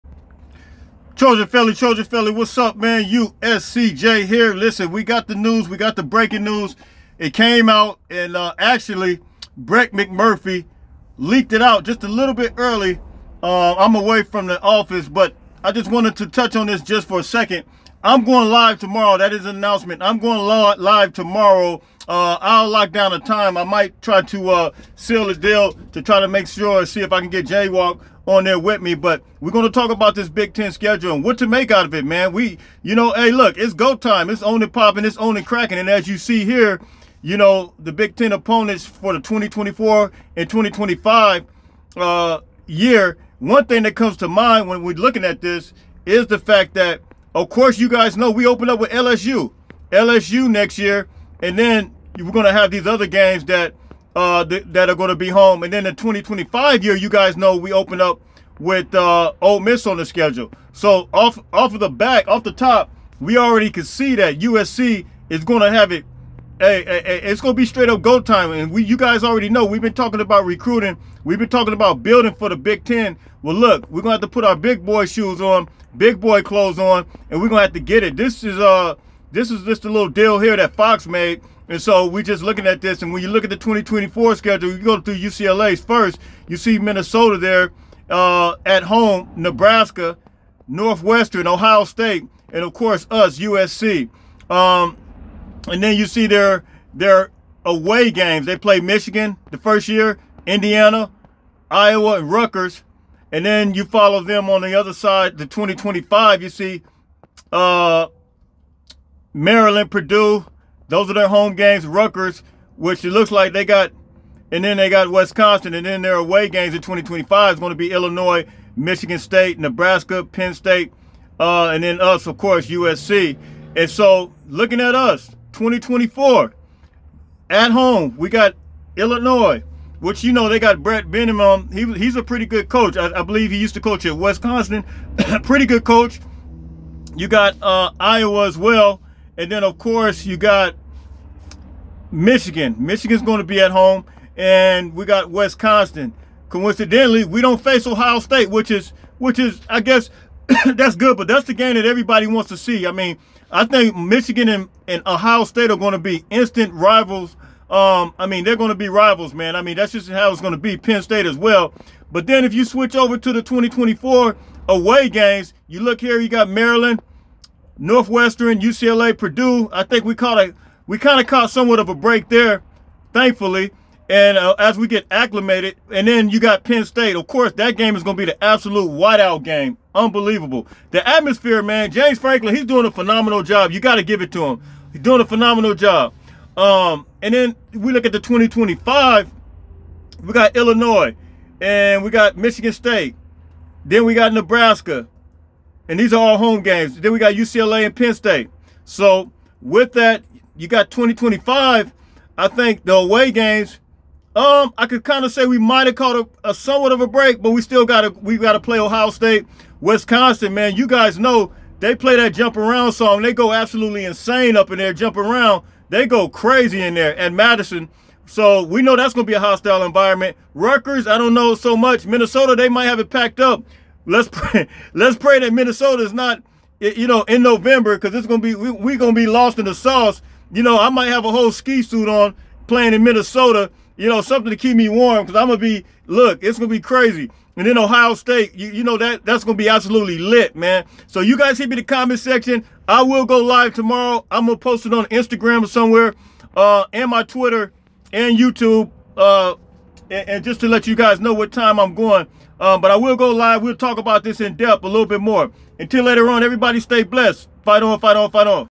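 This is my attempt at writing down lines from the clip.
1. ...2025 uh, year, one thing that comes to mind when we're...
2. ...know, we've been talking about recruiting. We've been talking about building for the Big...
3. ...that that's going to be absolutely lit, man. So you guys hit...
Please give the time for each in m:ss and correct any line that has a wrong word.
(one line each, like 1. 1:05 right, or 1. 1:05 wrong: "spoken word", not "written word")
1. 0:40 right
2. 1:09 right
3. 3:58 right.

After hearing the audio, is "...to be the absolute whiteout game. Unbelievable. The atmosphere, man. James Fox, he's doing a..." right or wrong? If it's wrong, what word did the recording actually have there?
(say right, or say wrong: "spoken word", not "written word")
wrong: "Franklin", not "Fox".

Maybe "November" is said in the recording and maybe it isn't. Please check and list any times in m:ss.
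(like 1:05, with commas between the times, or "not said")
3:47.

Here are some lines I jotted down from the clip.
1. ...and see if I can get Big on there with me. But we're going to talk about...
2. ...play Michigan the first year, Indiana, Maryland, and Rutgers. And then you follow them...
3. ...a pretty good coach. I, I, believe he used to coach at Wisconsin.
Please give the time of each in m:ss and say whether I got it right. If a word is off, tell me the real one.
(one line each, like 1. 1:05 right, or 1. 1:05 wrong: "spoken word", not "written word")
1. 0:26 wrong: "Jaywalk", not "Big"
2. 1:38 wrong: "Iowa", not "Maryland"
3. 2:12 right.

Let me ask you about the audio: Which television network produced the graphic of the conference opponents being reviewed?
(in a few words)
Fox.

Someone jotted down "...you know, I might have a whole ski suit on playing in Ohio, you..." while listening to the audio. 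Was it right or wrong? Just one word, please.
wrong.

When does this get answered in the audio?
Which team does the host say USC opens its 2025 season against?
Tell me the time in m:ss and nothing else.
0:59.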